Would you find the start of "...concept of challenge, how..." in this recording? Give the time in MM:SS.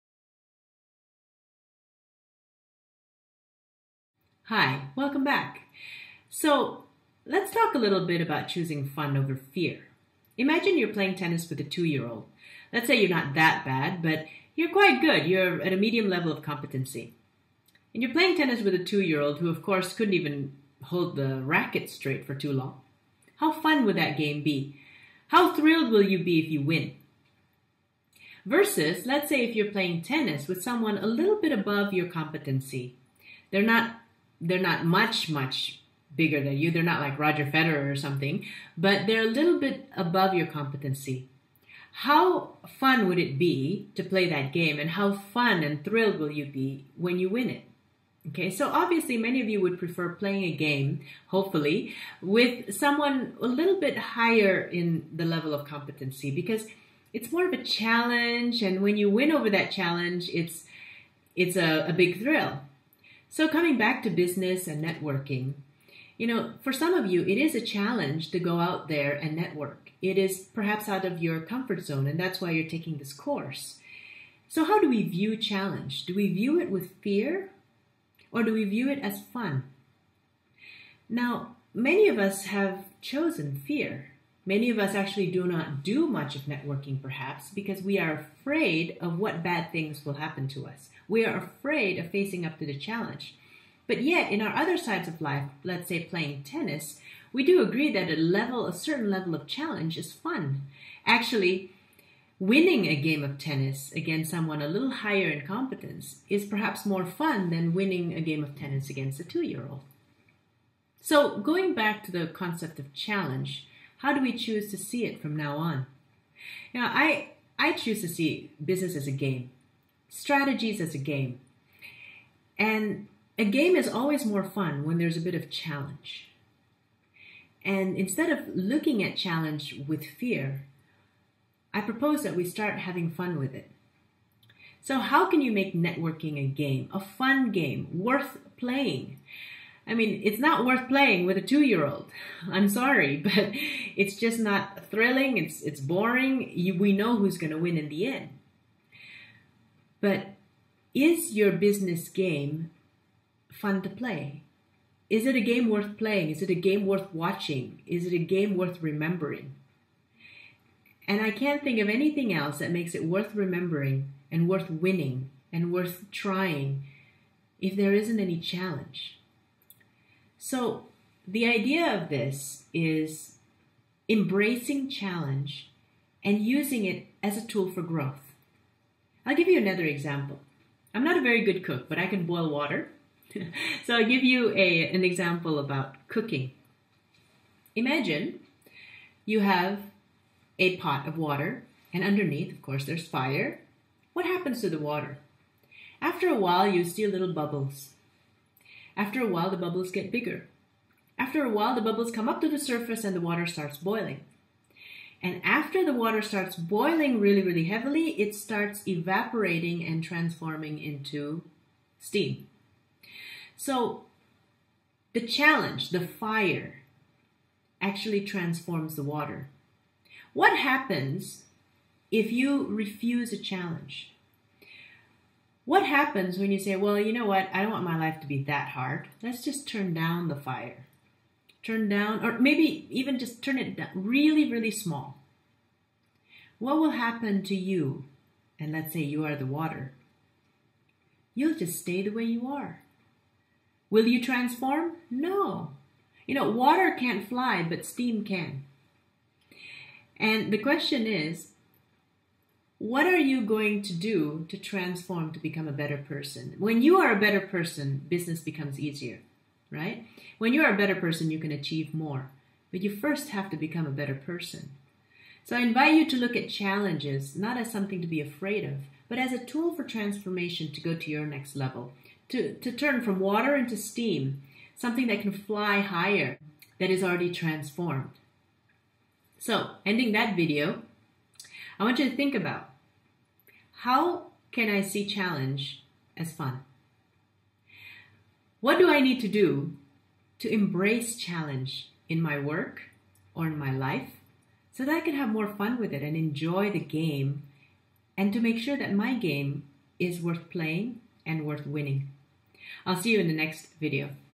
01:52.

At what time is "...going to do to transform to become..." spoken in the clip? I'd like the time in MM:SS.
04:13.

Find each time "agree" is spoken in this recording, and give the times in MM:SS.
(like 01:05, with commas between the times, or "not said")
01:37.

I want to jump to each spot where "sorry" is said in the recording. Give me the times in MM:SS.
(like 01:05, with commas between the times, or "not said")
02:22.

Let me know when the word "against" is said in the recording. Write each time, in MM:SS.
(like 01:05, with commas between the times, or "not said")
01:43, 01:48.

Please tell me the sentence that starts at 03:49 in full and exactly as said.
Let's just turn down the fire turn down, or maybe even just turn it down really, really small.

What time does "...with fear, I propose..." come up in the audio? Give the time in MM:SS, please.
02:09.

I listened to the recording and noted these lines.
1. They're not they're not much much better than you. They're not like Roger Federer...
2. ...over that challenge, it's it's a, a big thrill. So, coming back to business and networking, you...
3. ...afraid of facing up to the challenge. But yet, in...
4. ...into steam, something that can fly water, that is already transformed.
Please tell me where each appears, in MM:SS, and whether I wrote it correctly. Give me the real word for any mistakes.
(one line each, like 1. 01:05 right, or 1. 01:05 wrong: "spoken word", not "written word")
1. 00:33 wrong: "bigger", not "better"
2. 00:59 right
3. 01:31 right
4. 04:33 wrong: "higher", not "water".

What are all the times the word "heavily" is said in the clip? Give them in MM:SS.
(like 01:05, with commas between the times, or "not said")
03:27.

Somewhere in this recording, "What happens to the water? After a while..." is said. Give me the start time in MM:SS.
03:14.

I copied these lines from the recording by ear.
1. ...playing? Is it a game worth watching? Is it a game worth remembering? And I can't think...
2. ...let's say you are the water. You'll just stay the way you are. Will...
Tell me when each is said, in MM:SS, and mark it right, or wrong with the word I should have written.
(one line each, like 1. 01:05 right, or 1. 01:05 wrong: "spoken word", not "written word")
1. 02:35 right
2. 03:58 right.